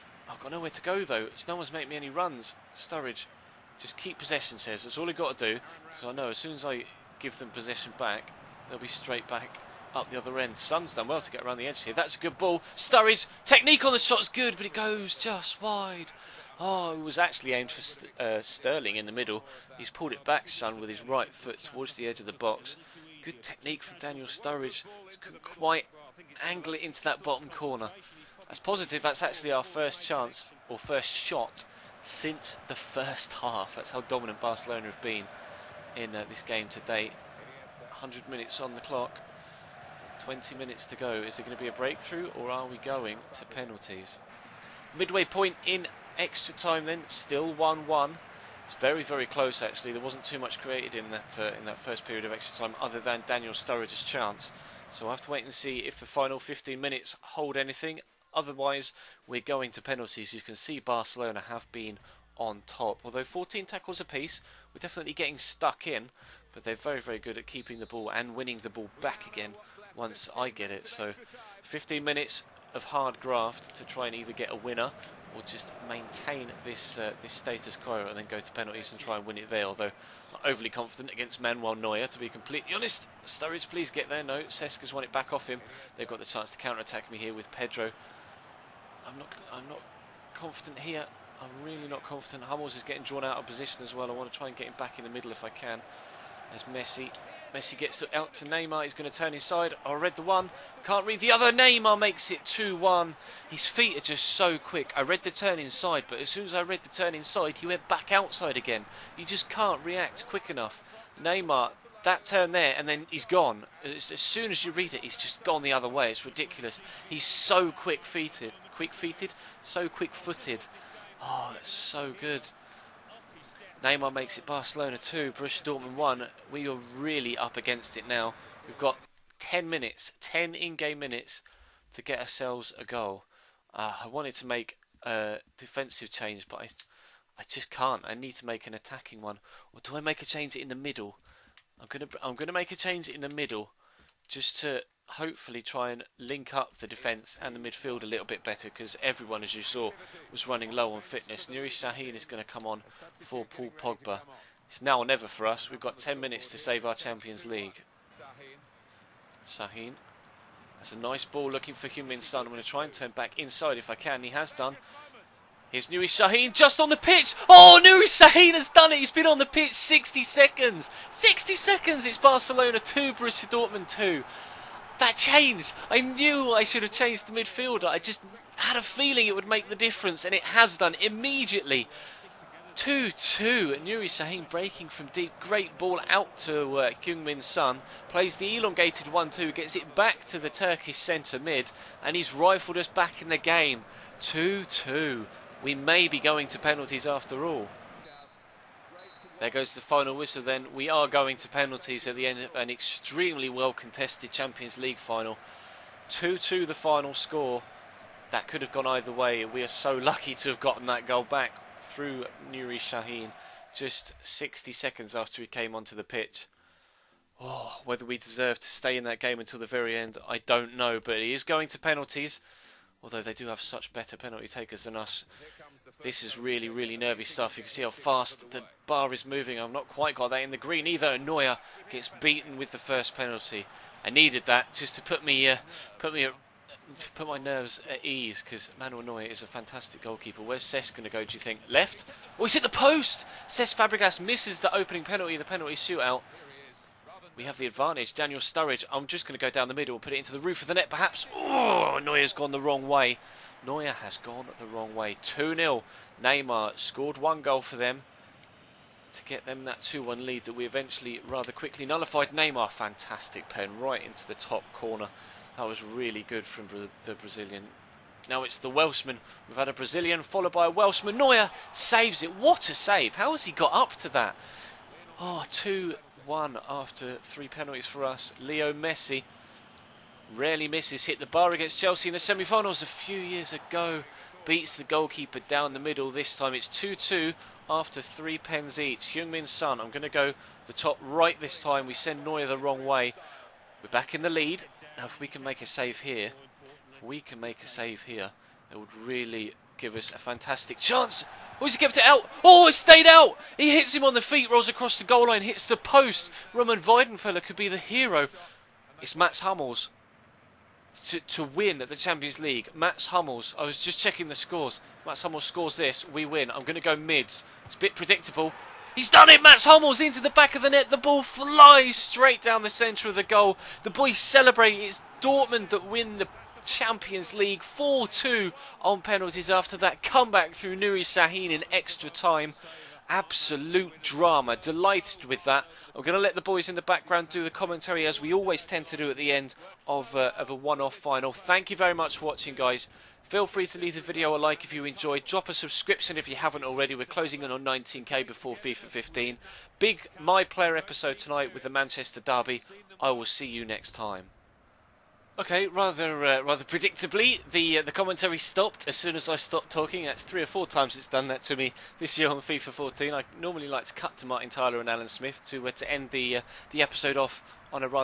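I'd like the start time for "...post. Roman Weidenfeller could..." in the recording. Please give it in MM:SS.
05:05.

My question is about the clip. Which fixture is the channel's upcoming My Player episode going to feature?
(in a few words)
Manchester Derby.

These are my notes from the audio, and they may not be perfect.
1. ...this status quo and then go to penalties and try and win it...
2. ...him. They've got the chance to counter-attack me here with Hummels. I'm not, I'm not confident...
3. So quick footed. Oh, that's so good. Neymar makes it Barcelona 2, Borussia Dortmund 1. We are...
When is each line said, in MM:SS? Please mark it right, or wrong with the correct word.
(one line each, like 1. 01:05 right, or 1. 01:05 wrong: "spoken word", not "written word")
1. 01:17 right
2. 01:25 wrong: "Pedro", not "Hummels"
3. 01:59 right.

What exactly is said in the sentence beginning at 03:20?
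We are going to penalties at the end of an extremely well contested Champions League final.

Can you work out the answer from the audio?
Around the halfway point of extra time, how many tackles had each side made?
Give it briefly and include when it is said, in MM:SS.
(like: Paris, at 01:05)
14, at 01:03.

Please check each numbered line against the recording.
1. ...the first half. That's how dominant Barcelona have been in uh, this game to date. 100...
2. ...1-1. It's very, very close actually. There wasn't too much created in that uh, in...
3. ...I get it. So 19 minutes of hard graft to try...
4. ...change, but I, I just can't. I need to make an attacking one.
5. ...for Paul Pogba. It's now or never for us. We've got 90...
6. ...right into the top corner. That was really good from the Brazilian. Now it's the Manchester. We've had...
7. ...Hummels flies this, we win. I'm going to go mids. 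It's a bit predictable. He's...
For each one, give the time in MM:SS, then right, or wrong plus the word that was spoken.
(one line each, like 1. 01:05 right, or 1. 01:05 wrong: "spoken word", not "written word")
1. 00:32 right
2. 00:47 right
3. 01:10 wrong: "15", not "19"
4. 02:16 right
5. 02:33 wrong: "10", not "90"
6. 04:23 wrong: "Welshman", not "Manchester"
7. 05:15 wrong: "scores", not "flies".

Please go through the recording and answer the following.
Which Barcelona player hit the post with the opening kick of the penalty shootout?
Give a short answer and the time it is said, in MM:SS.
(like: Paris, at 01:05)
Cesc Fabregas, at 04:03.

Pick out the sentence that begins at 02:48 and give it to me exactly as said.
He's been on the pitch 60 seconds.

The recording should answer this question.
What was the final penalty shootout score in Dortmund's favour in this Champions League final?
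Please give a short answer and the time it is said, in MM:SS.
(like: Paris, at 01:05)
4-2, at 05:27.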